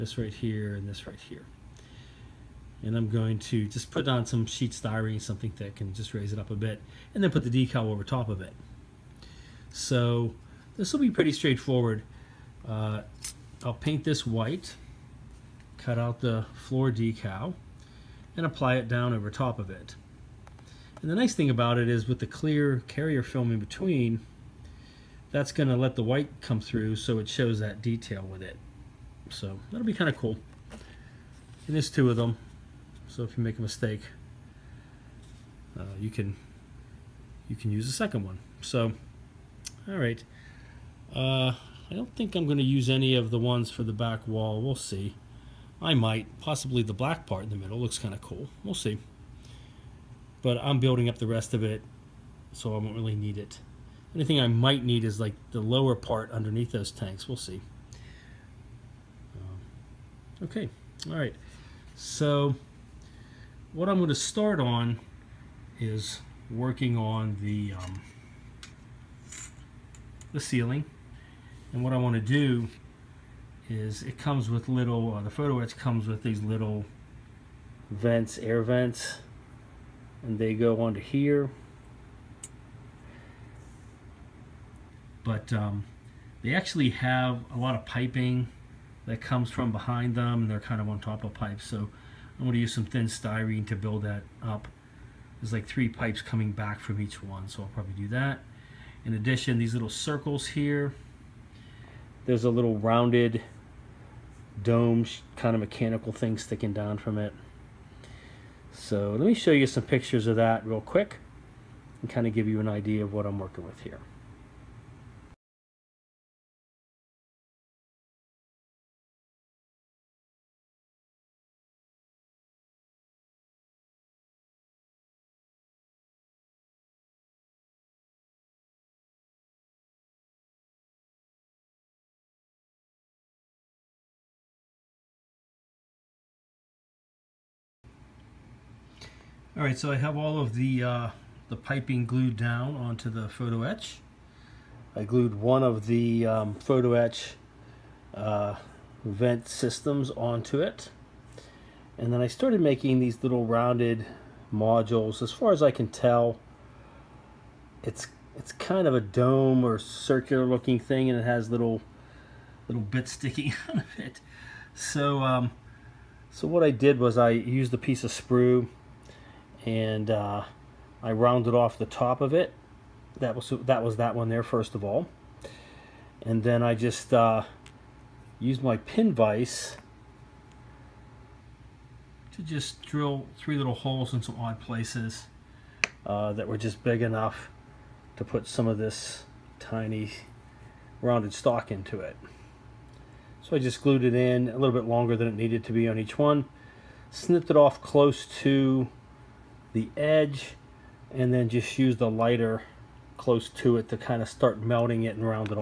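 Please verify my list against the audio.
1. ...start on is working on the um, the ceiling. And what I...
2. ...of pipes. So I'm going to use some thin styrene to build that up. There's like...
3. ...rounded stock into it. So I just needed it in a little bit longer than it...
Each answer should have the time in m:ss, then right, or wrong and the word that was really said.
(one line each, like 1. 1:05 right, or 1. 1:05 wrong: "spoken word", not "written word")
1. 1:04 right
2. 1:31 right
3. 3:11 wrong: "glued", not "needed".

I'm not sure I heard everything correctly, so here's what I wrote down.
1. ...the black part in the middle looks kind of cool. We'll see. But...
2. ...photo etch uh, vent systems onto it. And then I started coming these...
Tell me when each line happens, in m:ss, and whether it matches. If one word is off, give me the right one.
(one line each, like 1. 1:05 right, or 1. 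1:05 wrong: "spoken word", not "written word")
1. 0:46 right
2. 2:26 wrong: "making", not "coming".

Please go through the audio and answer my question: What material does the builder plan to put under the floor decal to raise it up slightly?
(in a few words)
Sheet styrene.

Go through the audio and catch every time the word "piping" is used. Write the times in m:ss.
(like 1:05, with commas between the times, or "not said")
1:27, 2:21.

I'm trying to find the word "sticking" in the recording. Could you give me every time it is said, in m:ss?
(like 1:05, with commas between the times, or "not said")
1:46, 2:43.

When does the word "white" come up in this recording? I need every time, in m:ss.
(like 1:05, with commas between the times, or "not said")
0:14, 0:26.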